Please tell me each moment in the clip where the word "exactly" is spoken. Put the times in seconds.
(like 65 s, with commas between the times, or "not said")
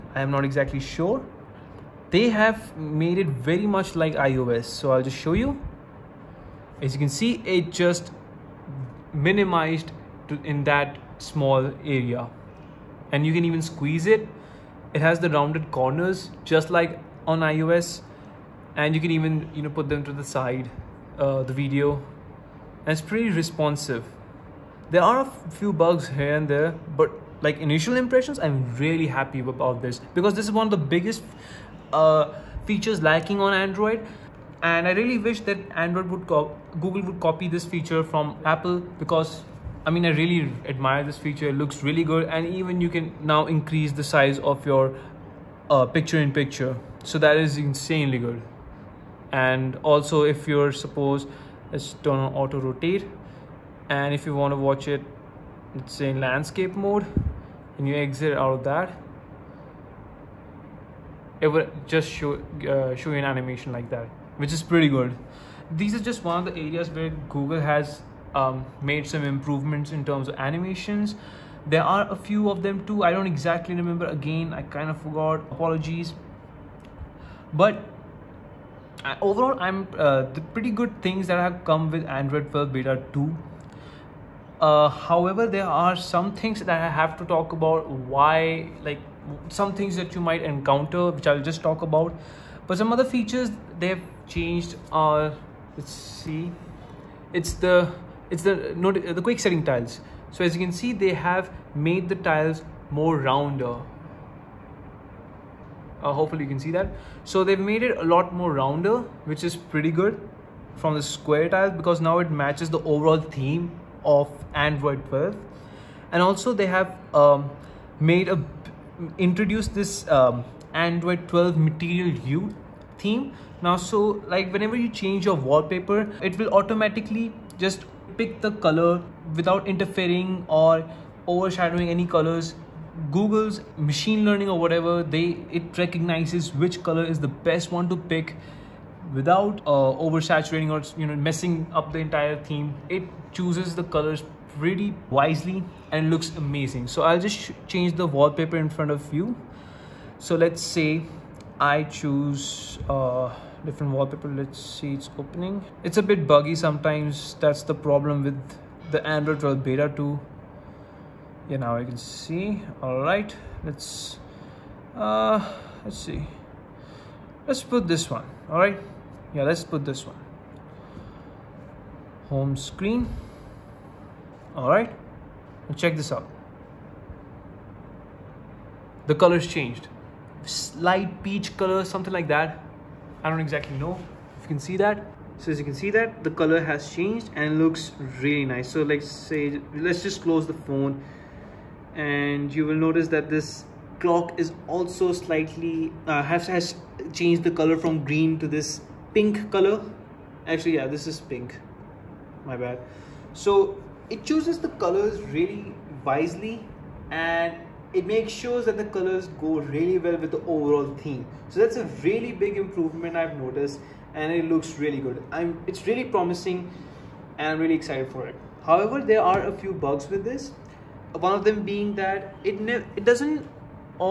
0 s, 73 s, 183 s.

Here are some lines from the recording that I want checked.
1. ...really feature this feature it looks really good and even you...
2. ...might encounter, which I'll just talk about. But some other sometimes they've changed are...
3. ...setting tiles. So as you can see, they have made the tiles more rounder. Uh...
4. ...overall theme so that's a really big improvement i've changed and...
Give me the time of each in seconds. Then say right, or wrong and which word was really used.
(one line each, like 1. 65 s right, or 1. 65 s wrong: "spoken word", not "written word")
1. 40 s wrong: "admire", not "feature"
2. 90 s wrong: "features", not "sometimes"
3. 99 s right
4. 210 s wrong: "noticed", not "changed".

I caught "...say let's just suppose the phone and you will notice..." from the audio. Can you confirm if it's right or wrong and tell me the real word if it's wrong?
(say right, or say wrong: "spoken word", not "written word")
wrong: "close", not "suppose".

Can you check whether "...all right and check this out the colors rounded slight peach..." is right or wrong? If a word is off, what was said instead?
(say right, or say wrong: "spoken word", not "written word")
wrong: "changed", not "rounded".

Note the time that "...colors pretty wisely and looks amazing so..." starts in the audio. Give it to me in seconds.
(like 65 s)
143 s.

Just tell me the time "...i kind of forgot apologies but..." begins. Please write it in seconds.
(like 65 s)
74 s.